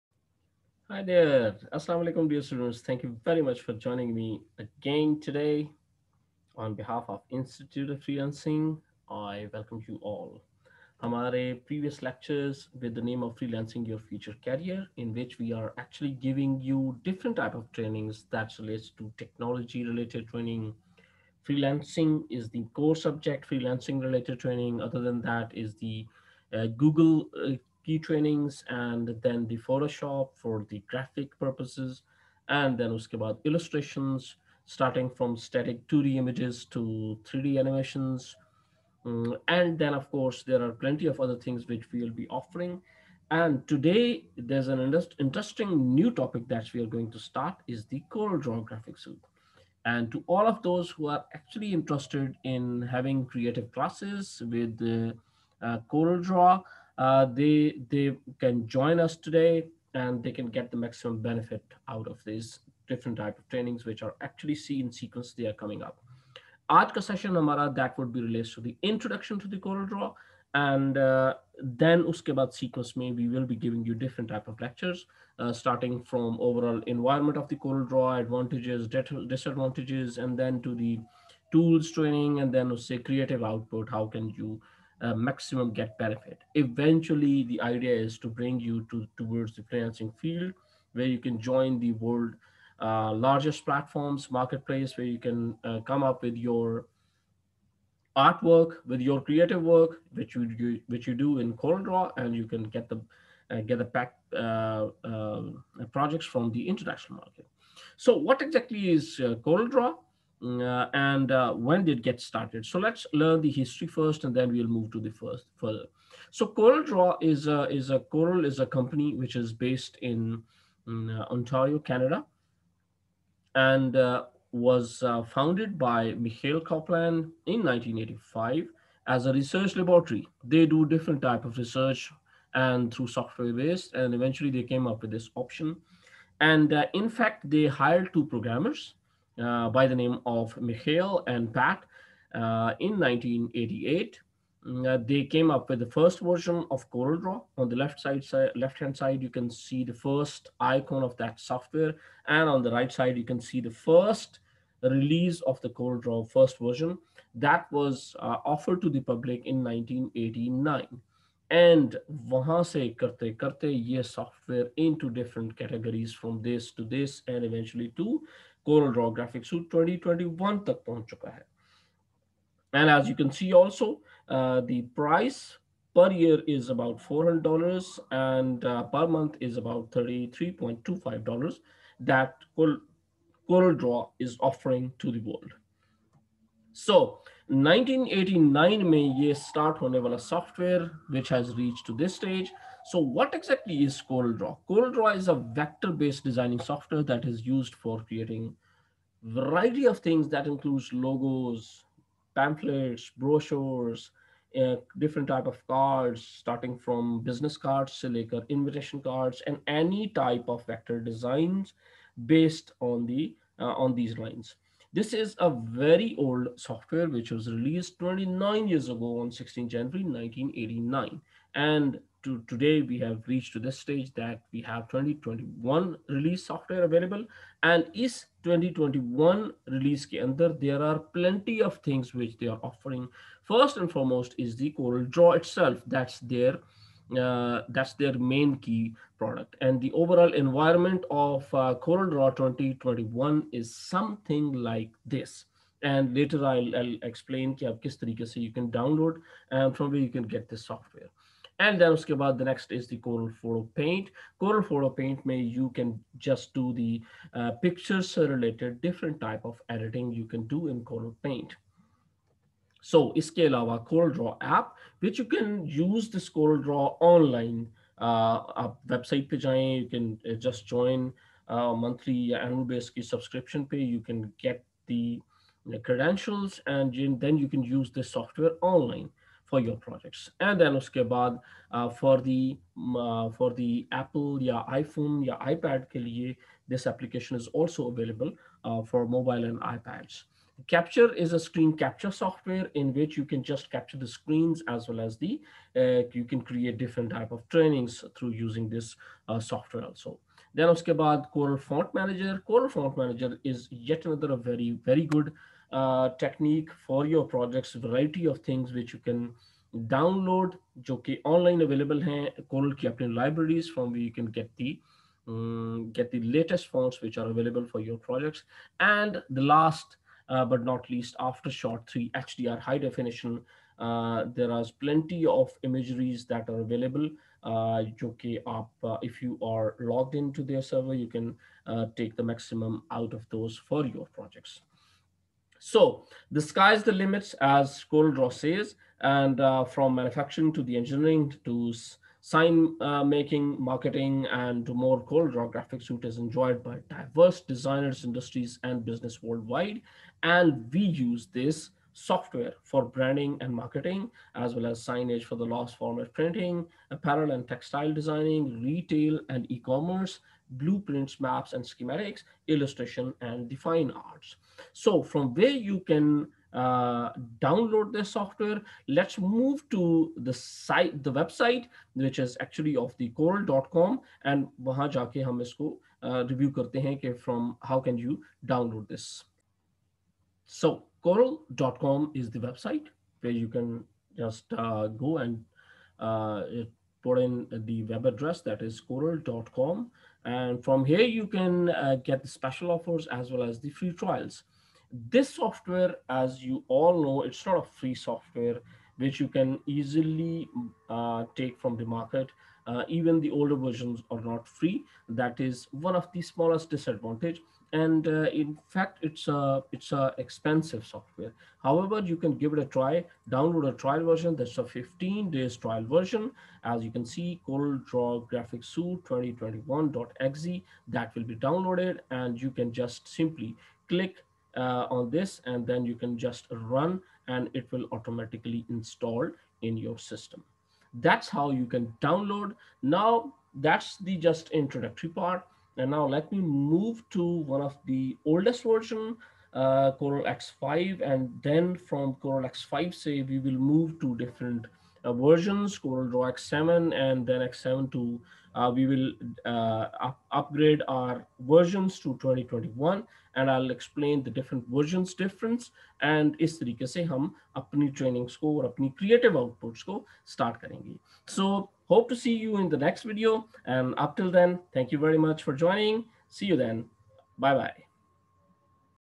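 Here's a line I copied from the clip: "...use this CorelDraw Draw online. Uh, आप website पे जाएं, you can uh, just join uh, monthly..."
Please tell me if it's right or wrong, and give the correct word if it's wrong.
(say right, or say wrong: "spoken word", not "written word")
right.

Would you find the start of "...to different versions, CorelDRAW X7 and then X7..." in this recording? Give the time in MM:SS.
07:24.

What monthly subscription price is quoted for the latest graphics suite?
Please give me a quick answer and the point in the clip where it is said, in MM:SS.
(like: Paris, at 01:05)
$33.25, at 02:59.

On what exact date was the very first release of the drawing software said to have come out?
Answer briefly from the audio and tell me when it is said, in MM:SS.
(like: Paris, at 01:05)
16 January 1989, at 03:39.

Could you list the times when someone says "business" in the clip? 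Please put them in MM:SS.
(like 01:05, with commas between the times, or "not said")
03:27, 05:48.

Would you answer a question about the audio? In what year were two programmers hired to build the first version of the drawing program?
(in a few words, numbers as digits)
1988.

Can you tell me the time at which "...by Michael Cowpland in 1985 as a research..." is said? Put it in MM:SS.
02:05.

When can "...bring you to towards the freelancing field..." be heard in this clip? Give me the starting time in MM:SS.
01:28.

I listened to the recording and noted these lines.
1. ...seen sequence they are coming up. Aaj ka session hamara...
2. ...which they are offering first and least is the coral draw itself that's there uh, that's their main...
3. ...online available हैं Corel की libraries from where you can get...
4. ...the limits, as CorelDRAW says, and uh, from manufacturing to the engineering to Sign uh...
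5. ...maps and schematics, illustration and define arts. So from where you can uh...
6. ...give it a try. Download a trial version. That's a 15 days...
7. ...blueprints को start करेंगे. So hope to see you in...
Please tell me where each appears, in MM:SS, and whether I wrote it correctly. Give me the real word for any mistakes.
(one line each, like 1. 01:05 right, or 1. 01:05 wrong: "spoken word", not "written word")
1. 01:04 right
2. 03:52 wrong: "foremost", not "least"
3. 05:11 right
4. 05:36 right
5. 06:01 right
6. 06:52 right
7. 07:39 wrong: "outputs", not "blueprints".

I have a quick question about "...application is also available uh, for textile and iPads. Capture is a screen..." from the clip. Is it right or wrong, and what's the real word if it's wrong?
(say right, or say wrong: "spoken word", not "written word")
wrong: "mobile", not "textile".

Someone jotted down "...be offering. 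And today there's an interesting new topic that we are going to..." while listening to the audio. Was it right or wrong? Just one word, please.
right.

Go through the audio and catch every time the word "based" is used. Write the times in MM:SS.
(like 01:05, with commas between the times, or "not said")
01:59, 02:13, 03:15, 03:32.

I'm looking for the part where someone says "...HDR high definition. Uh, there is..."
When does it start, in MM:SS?
05:22.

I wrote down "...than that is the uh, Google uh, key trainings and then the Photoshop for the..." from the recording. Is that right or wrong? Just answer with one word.
right.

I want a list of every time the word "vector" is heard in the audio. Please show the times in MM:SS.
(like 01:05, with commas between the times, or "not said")
03:15, 03:30.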